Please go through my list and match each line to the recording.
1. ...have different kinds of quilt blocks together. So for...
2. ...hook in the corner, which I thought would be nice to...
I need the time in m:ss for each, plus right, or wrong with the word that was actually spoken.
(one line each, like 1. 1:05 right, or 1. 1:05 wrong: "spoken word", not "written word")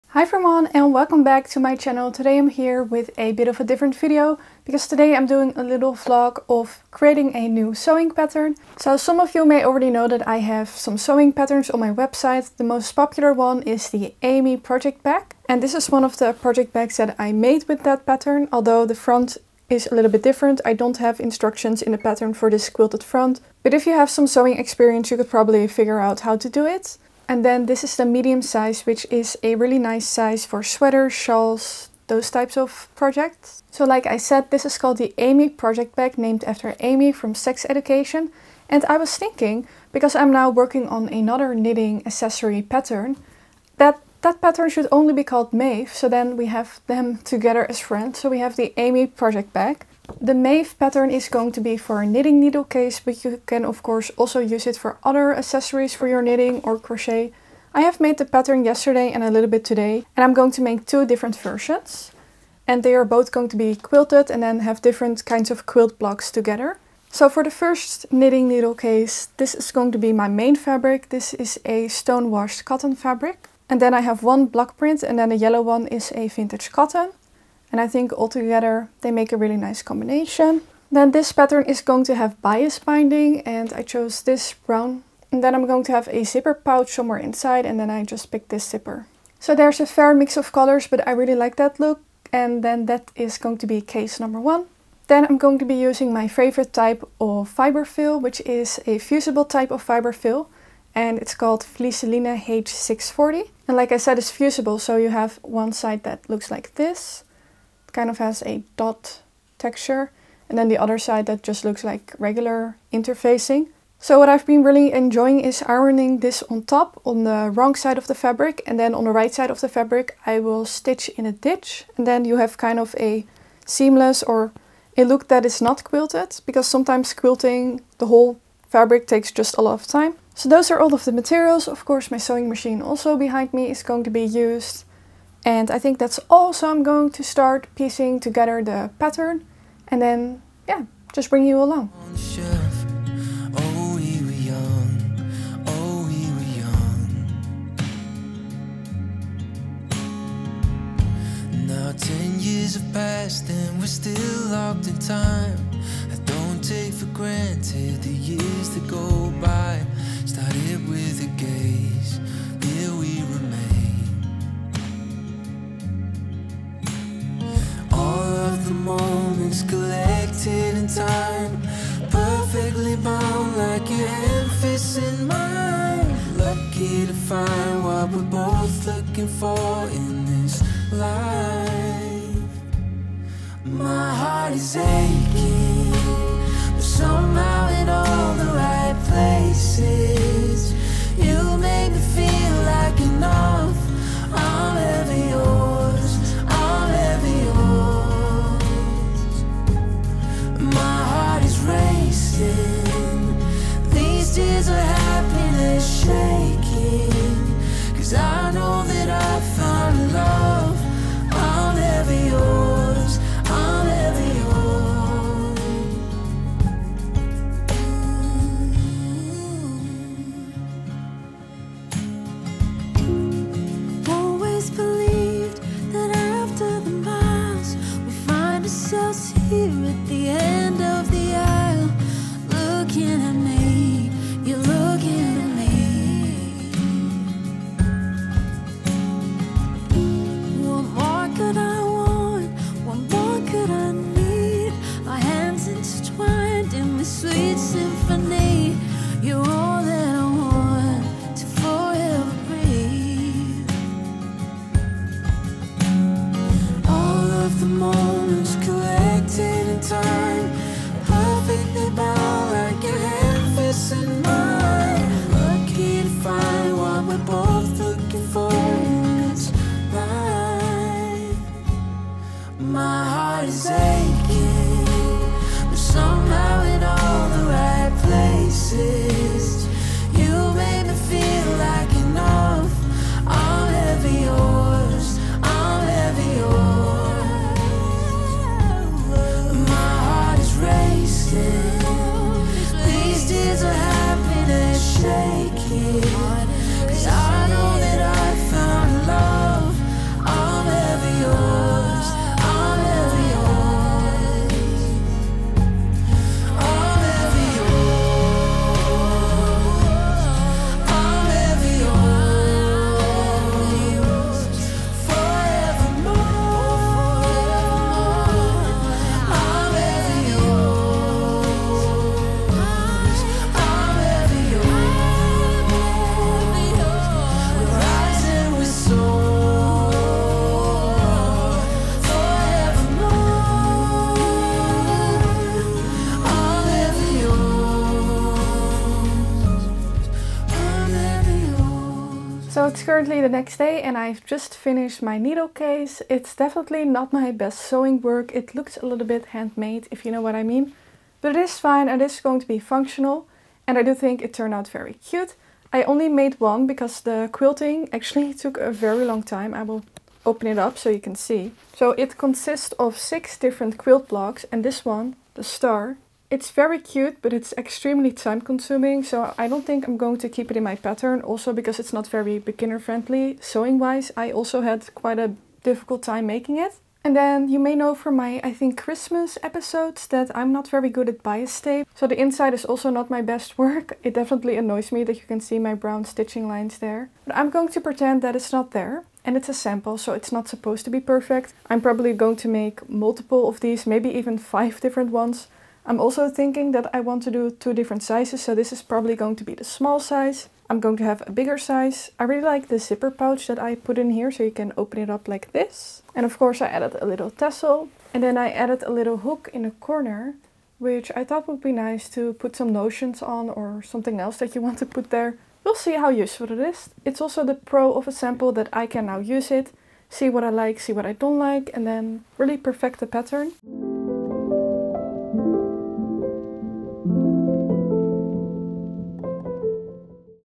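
1. 1:04 right
2. 6:49 right.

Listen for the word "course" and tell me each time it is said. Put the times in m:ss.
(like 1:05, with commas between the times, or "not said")
0:53, 2:11, 6:46.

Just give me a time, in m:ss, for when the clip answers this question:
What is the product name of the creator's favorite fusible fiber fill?
1:41.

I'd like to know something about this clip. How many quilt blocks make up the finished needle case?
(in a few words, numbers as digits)
6.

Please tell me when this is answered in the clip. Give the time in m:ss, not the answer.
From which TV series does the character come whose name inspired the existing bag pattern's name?
0:37.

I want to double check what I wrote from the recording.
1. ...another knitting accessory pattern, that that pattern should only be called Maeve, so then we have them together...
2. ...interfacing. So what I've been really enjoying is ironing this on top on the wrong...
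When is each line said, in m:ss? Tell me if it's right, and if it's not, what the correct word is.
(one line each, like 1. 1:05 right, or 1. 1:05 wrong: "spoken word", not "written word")
1. 0:41 right
2. 1:52 right.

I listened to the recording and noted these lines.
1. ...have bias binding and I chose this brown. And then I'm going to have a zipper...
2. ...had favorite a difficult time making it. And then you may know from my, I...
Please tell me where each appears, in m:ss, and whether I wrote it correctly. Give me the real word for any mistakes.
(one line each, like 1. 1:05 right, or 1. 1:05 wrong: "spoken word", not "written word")
1. 1:22 right
2. 6:14 wrong: "quite", not "favorite".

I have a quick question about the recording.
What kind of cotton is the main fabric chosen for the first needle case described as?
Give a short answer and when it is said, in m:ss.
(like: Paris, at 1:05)
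stone washed cotton, at 1:11.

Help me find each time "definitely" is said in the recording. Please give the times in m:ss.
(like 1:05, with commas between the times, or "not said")
5:46, 6:24.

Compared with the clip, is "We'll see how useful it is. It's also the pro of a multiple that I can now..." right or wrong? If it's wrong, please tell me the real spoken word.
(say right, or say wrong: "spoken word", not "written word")
wrong: "sample", not "multiple".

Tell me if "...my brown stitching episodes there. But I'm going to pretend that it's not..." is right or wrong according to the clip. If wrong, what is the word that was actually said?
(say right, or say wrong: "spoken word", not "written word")
wrong: "lines", not "episodes".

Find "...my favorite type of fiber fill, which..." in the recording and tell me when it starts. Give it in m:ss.
1:36.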